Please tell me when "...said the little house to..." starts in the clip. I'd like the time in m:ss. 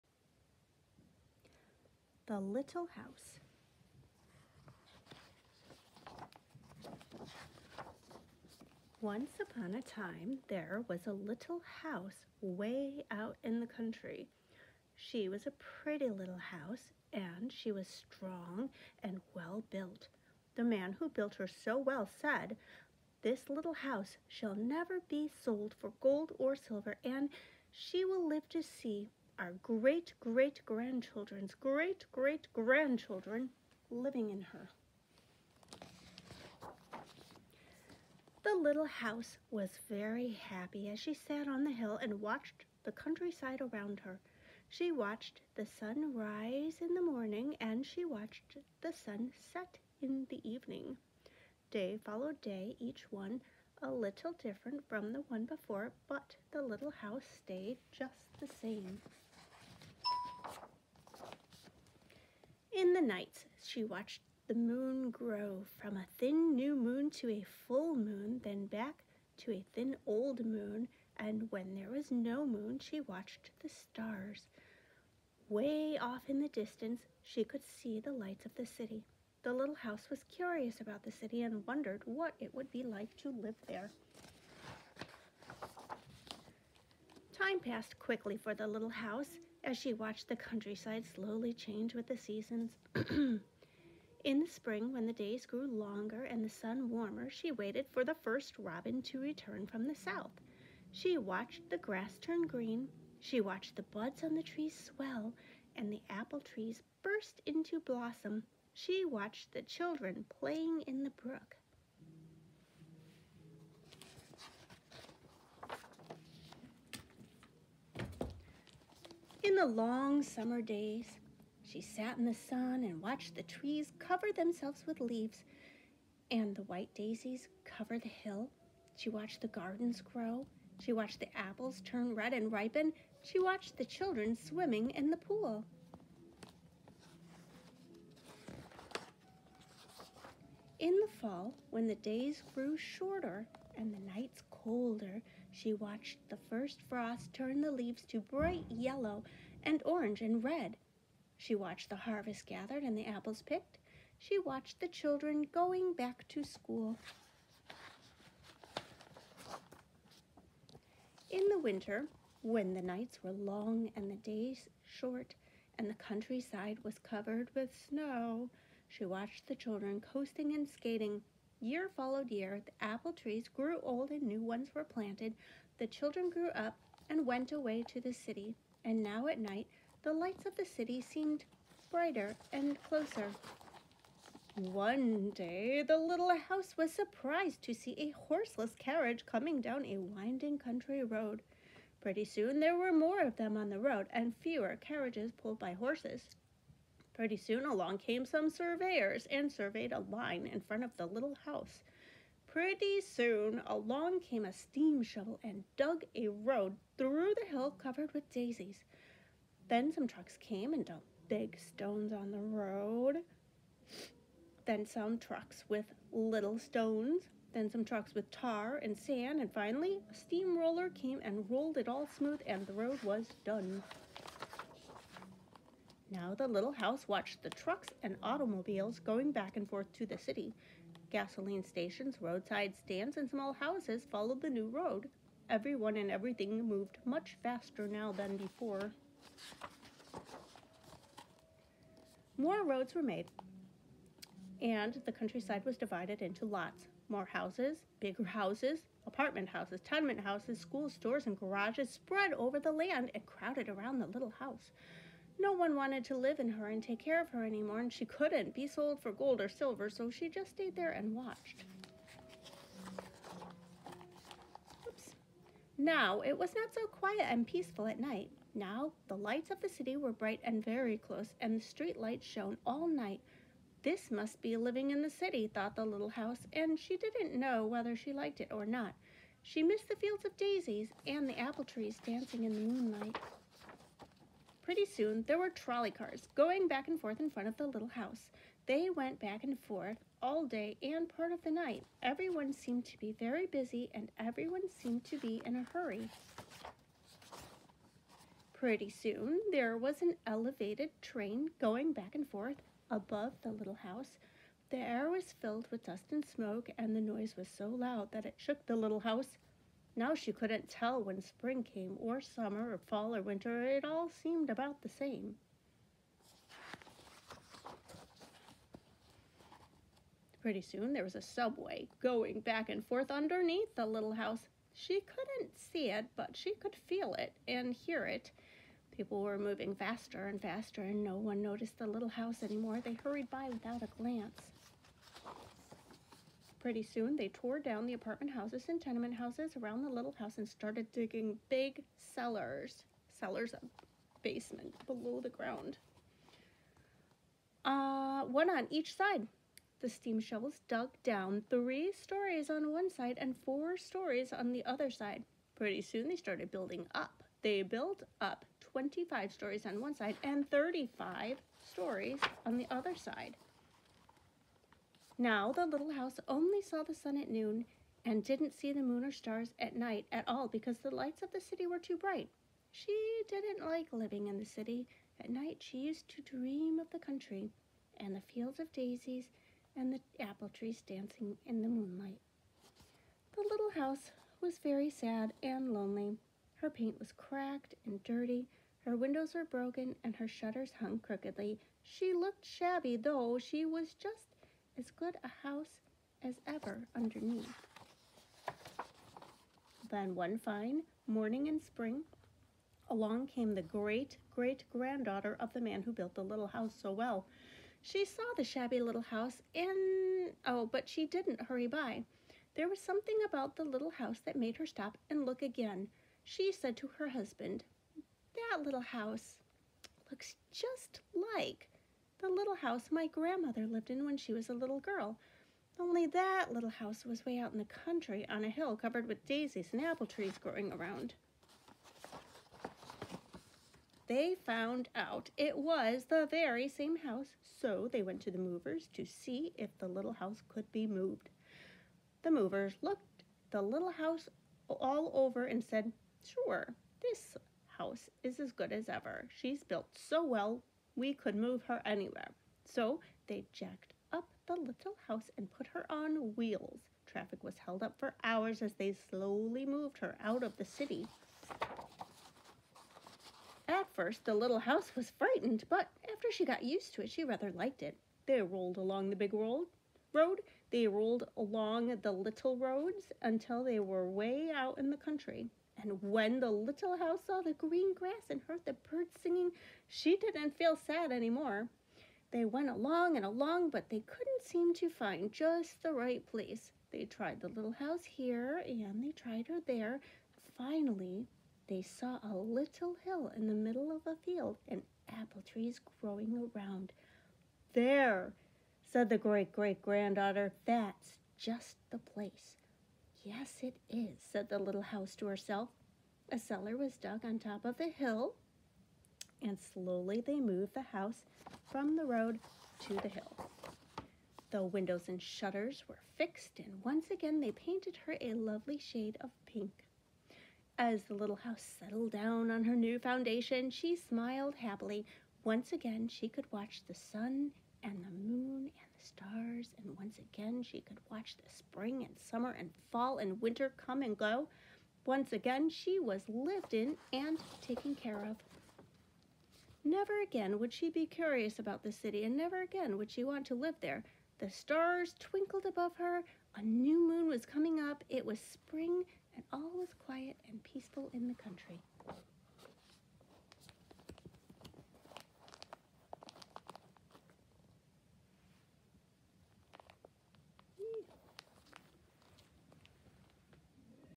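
8:24.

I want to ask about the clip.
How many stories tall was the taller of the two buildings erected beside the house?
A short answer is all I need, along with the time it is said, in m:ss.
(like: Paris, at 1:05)
35, at 6:00.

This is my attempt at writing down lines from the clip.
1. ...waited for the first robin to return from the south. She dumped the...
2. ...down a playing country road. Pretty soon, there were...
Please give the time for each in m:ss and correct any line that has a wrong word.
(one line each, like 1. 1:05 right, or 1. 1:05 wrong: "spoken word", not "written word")
1. 1:37 wrong: "watched", not "dumped"
2. 3:09 wrong: "winding", not "playing".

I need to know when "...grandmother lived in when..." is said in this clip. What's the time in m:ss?
7:03.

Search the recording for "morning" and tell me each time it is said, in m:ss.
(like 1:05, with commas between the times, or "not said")
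0:47, 6:41.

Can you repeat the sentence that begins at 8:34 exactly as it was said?
The windows and shutters were fixed, and once again they painted her a lovely shade of pink.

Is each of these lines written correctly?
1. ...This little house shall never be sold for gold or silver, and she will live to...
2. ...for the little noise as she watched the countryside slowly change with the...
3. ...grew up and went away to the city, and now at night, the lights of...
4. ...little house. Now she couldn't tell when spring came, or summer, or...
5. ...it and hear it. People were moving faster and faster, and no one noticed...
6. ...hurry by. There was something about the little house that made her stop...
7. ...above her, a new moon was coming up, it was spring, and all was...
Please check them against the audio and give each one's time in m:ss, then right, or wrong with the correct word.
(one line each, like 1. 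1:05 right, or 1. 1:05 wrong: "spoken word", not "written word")
1. 0:23 right
2. 1:28 wrong: "house", not "noise"
3. 2:56 right
4. 5:08 right
5. 5:27 right
6. 6:51 right
7. 9:05 right.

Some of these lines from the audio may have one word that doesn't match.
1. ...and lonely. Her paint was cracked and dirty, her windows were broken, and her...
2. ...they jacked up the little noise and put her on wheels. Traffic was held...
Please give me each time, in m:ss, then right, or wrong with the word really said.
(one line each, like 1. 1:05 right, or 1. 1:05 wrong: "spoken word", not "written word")
1. 6:25 right
2. 7:33 wrong: "house", not "noise".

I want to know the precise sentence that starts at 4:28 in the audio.
Now, the lights of the city were bright and very close, and the street lights shone all night.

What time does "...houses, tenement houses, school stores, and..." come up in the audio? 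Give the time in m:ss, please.
4:09.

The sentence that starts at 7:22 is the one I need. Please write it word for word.
The movers looked the little house all over and said, Sure, this house is as good as ever.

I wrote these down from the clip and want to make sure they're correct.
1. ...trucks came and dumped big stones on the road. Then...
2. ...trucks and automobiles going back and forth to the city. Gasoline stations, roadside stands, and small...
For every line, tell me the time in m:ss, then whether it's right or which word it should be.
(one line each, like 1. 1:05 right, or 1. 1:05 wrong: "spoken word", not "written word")
1. 3:30 right
2. 3:47 right.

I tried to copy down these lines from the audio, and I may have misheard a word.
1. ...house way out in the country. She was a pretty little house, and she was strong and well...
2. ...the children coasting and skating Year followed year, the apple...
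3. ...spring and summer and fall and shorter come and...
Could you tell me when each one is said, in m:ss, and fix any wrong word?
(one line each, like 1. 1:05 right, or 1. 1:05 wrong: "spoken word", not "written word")
1. 0:11 right
2. 2:49 right
3. 8:51 wrong: "winter", not "shorter".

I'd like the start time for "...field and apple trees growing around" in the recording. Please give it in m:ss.
8:14.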